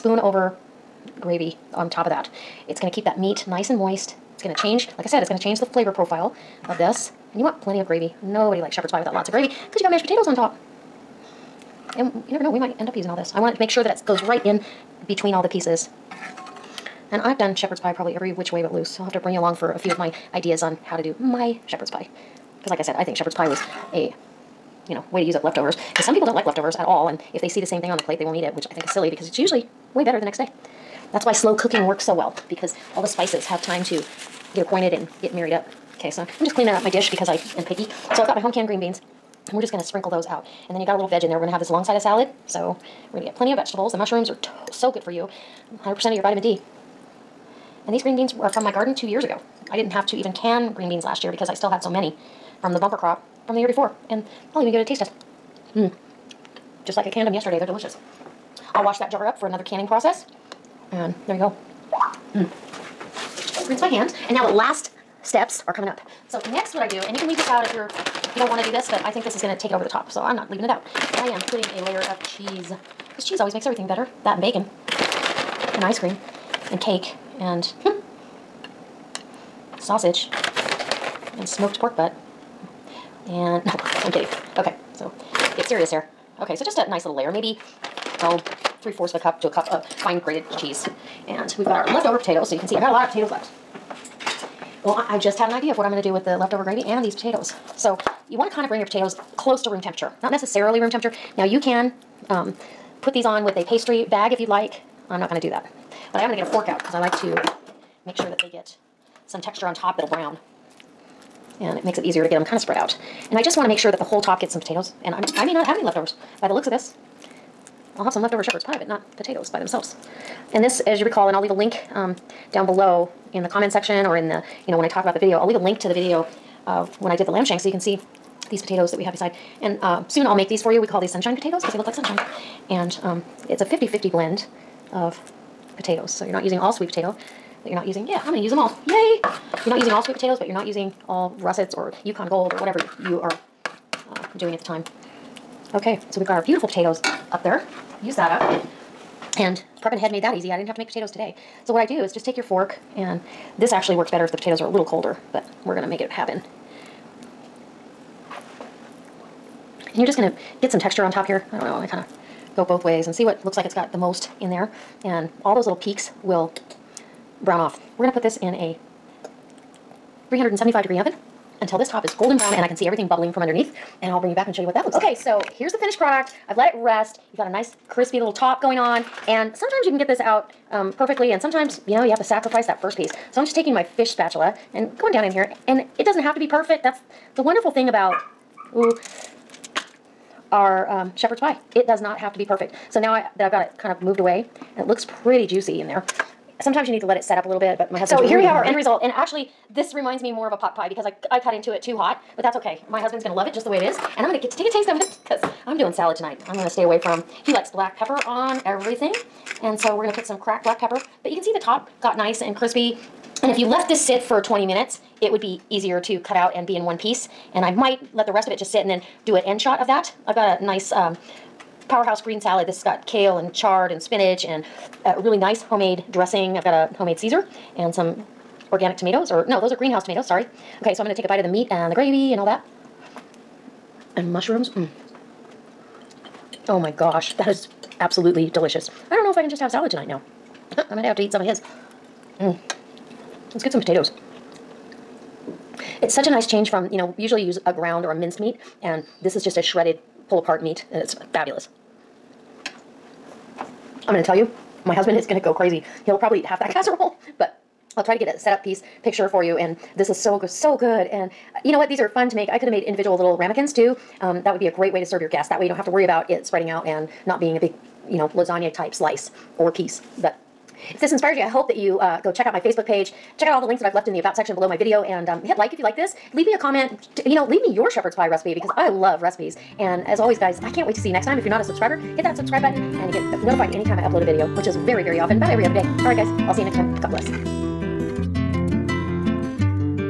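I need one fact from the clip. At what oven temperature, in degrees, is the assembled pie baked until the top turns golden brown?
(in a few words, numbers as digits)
375.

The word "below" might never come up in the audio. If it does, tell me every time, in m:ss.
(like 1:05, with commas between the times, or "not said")
2:02, 4:34.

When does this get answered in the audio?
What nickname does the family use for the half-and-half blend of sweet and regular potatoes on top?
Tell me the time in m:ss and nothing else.
2:11.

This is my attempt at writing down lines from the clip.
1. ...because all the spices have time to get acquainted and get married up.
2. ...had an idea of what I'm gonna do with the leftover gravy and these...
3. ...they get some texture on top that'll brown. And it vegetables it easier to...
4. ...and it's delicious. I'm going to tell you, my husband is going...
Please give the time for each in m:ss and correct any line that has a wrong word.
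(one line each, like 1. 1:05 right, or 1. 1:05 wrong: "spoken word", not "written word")
1. 0:32 right
2. 1:35 right
3. 1:48 wrong: "makes", not "vegetables"
4. 4:10 wrong: "fabulous", not "delicious".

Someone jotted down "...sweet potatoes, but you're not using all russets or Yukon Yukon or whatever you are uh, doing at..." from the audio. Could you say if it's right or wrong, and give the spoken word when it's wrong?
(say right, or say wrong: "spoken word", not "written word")
wrong: "Gold", not "Yukon".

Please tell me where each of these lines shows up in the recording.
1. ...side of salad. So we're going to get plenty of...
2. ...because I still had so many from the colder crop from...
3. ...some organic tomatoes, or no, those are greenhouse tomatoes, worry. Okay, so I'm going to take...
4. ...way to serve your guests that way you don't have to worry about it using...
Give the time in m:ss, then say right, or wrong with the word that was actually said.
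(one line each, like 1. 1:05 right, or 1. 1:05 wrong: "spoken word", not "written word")
1. 0:41 right
2. 0:51 wrong: "bumper", not "colder"
3. 3:47 wrong: "sorry", not "worry"
4. 4:24 wrong: "spreading", not "using".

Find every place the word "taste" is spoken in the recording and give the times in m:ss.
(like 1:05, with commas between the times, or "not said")
0:54, 3:24.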